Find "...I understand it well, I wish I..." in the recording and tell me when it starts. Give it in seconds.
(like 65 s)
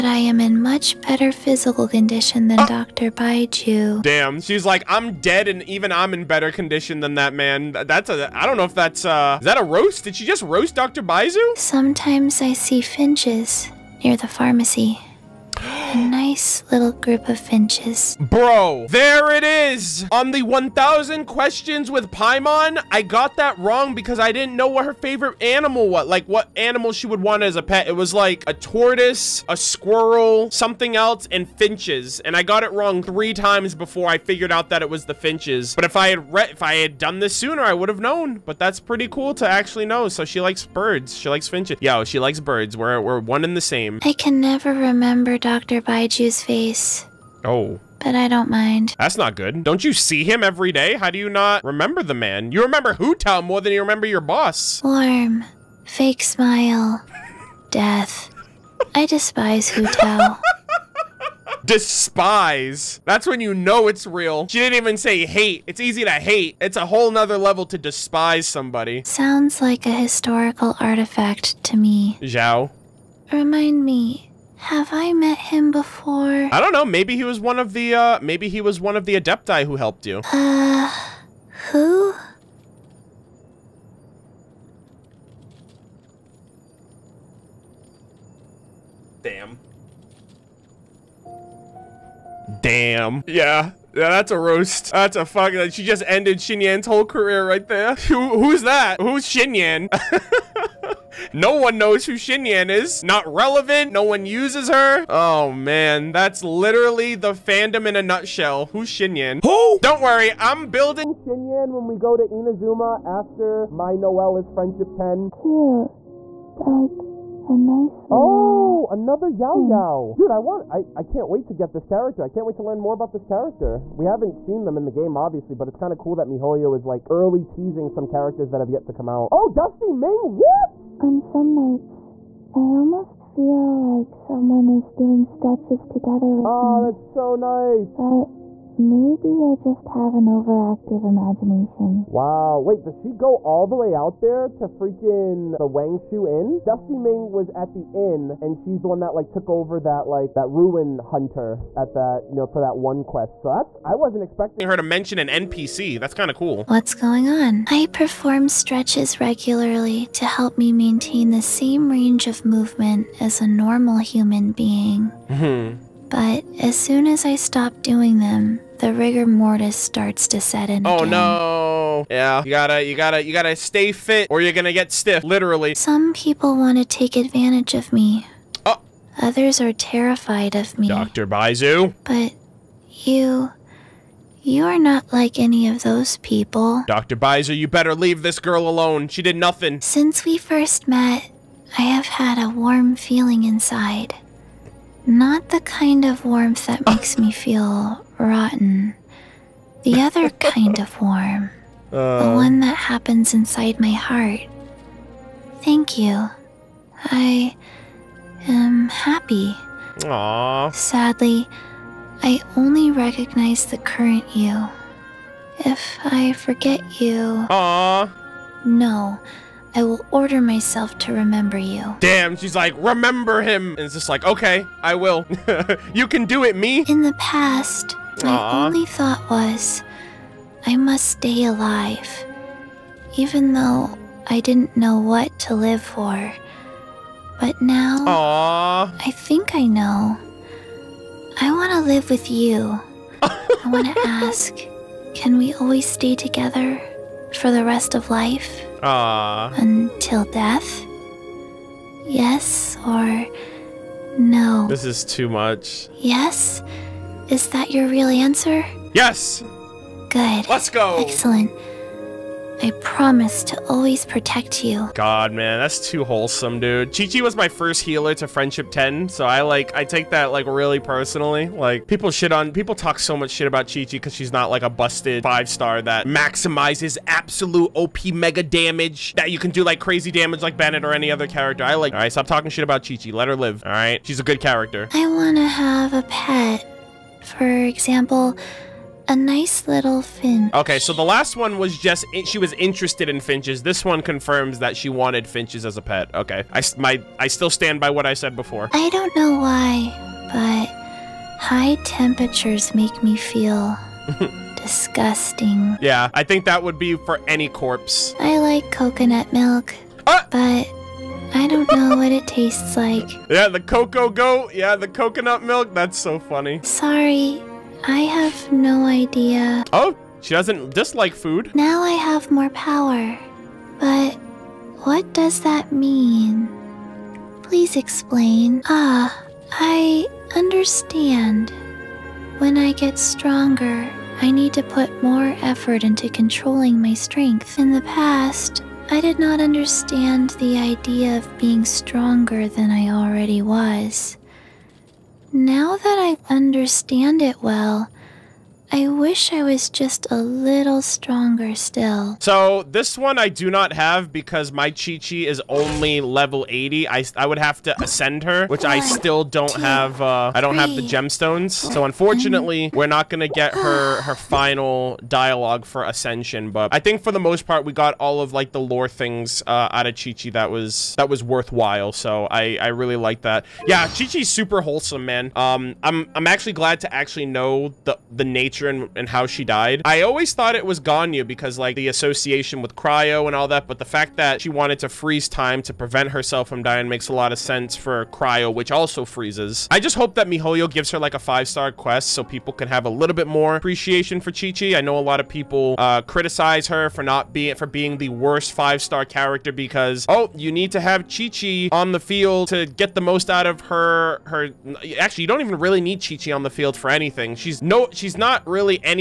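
345 s.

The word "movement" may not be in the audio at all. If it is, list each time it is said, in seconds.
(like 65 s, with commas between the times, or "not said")
162 s.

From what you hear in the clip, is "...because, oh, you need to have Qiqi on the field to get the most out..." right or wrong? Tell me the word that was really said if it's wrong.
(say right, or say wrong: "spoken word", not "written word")
right.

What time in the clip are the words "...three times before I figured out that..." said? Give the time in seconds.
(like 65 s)
33 s.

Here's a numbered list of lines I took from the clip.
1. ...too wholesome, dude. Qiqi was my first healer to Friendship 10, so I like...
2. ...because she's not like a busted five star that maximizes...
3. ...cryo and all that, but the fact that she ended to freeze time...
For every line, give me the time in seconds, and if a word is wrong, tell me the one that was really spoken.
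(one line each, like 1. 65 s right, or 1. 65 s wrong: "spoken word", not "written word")
1. 265 s right
2. 273 s right
3. 382 s wrong: "wanted", not "ended".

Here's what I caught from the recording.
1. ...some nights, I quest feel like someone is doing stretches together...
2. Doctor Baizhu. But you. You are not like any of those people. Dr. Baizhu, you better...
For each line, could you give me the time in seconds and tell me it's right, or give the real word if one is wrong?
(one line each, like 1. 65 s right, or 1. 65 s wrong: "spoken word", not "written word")
1. 131 s wrong: "almost", not "quest"
2. 180 s right.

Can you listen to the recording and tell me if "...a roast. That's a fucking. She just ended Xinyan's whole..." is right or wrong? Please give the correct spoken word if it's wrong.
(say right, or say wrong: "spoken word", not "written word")
right.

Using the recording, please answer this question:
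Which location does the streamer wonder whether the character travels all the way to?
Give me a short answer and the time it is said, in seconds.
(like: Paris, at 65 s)
Wangshu Inn, at 145 s.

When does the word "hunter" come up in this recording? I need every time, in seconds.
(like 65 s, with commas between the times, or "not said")
150 s.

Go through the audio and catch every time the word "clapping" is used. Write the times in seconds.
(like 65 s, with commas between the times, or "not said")
not said.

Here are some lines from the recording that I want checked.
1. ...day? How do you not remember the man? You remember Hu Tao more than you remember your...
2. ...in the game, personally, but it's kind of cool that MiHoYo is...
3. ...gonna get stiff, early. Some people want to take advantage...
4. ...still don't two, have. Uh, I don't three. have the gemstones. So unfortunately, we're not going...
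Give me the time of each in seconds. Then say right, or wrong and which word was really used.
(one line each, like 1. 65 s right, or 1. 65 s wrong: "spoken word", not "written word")
1. 50 s right
2. 124 s wrong: "obviously", not "personally"
3. 174 s wrong: "literally", not "early"
4. 358 s right.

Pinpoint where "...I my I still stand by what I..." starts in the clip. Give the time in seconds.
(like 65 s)
296 s.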